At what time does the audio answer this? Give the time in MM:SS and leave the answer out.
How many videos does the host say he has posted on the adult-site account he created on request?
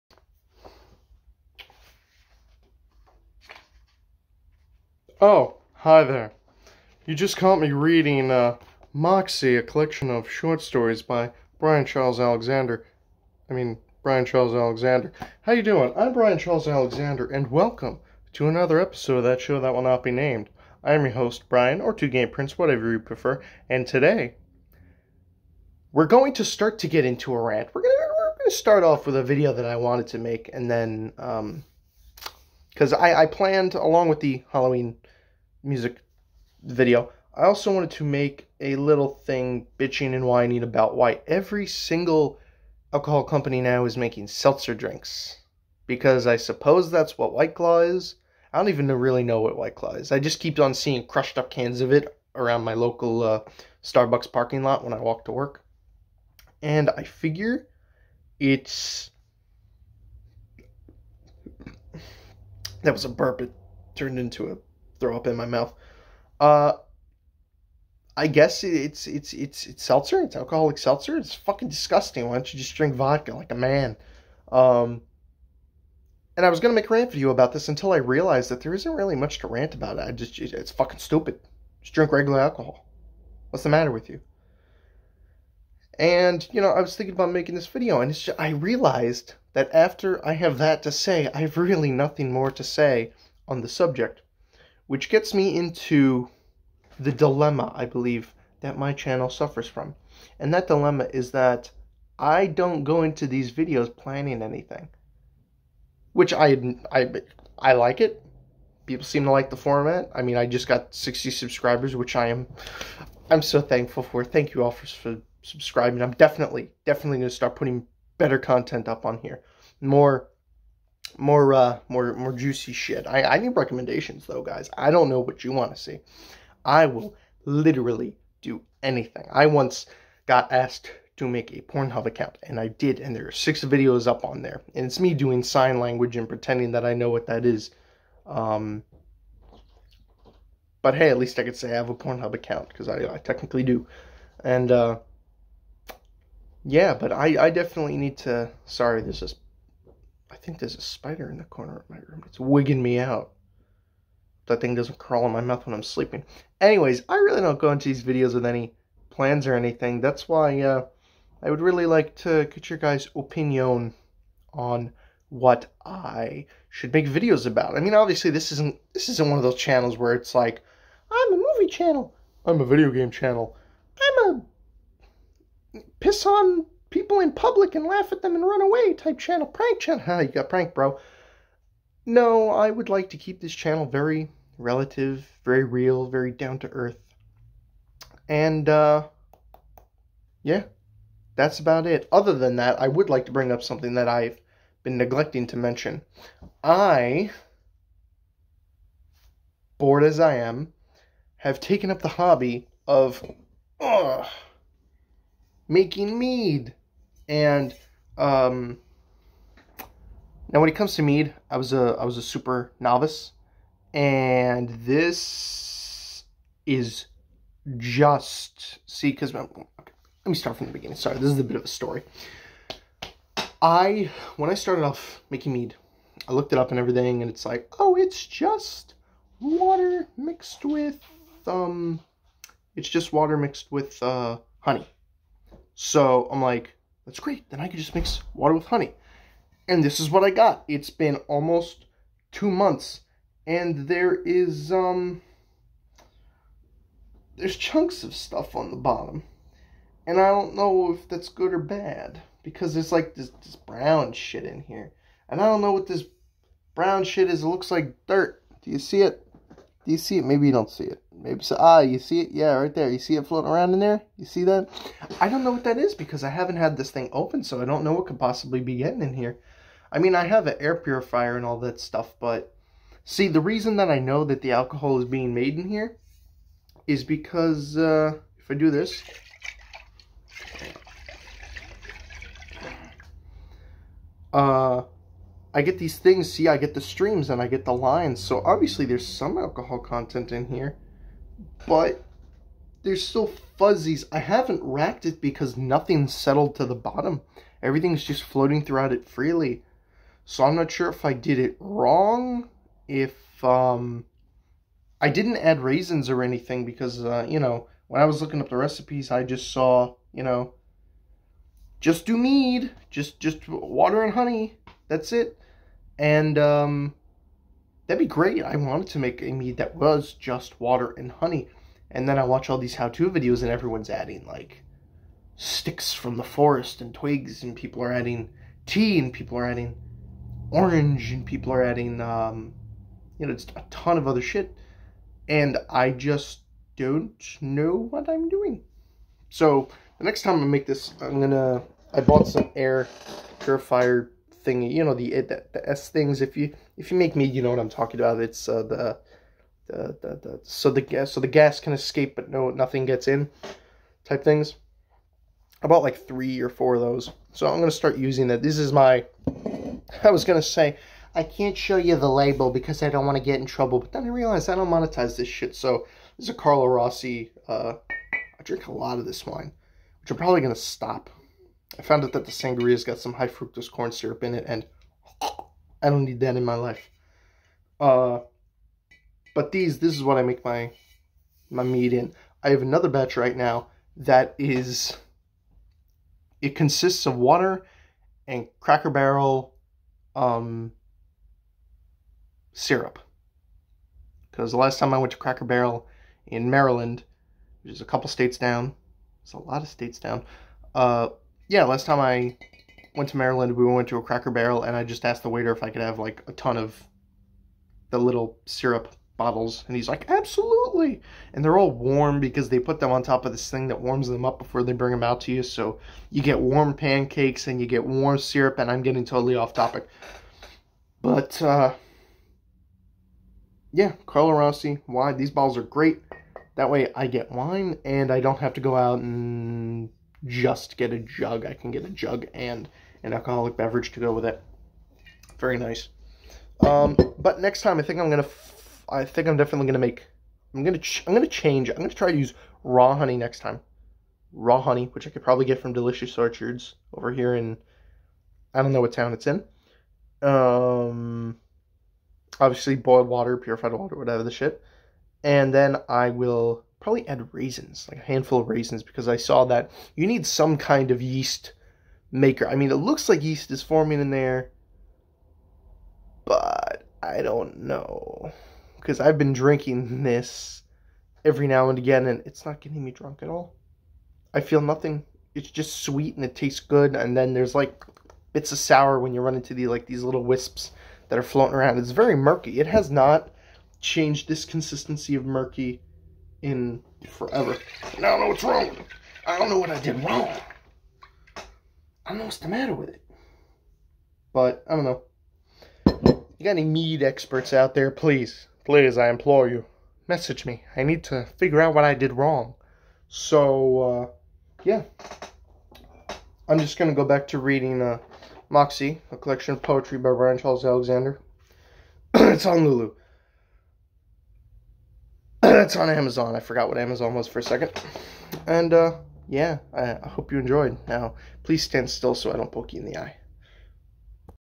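02:13.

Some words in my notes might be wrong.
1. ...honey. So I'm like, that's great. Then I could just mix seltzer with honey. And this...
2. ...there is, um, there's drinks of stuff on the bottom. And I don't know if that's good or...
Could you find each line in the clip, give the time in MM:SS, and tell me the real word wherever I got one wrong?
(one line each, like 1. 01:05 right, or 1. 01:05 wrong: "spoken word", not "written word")
1. 03:54 wrong: "water", not "seltzer"
2. 04:03 wrong: "chunks", not "drinks".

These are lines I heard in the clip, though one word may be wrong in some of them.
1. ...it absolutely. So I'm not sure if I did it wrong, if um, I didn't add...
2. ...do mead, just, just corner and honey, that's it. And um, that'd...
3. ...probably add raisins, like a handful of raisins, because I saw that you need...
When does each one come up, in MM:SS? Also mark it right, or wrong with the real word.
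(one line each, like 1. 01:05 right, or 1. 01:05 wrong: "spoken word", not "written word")
1. 04:58 wrong: "freely", not "absolutely"
2. 05:12 wrong: "water", not "corner"
3. 07:36 right.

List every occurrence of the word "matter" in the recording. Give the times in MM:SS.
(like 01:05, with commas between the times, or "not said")
01:23, 08:12.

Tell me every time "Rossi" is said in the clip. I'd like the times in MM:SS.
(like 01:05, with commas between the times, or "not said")
06:06, 07:04.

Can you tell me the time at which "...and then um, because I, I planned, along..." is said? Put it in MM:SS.
00:30.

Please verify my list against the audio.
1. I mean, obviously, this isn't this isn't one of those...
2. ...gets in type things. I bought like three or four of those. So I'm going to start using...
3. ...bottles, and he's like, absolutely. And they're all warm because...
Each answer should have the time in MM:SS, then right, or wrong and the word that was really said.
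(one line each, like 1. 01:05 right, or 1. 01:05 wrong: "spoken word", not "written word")
1. 02:47 right
2. 05:52 right
3. 06:49 right.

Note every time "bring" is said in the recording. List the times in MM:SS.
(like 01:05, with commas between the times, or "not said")
03:13, 06:54.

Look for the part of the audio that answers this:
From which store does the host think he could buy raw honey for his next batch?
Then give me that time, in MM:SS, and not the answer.
07:25.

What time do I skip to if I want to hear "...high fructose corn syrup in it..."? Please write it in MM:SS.
06:13.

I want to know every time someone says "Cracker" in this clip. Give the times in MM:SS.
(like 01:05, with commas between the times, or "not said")
06:28, 06:35, 06:44.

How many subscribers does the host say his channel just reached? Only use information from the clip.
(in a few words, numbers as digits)
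60.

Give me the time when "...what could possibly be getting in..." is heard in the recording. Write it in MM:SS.
04:27.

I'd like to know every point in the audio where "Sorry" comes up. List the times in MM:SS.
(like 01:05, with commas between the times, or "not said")
02:28, 03:40.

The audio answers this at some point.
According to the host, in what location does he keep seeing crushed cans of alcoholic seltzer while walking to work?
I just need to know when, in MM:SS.
00:53.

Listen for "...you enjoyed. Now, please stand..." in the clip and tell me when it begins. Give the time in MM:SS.
08:40.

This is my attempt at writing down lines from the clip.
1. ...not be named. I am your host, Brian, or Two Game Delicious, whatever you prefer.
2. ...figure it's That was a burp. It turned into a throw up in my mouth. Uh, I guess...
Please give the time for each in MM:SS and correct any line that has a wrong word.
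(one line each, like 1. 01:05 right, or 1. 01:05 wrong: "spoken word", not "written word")
1. 00:19 wrong: "Prince", not "Delicious"
2. 00:57 right.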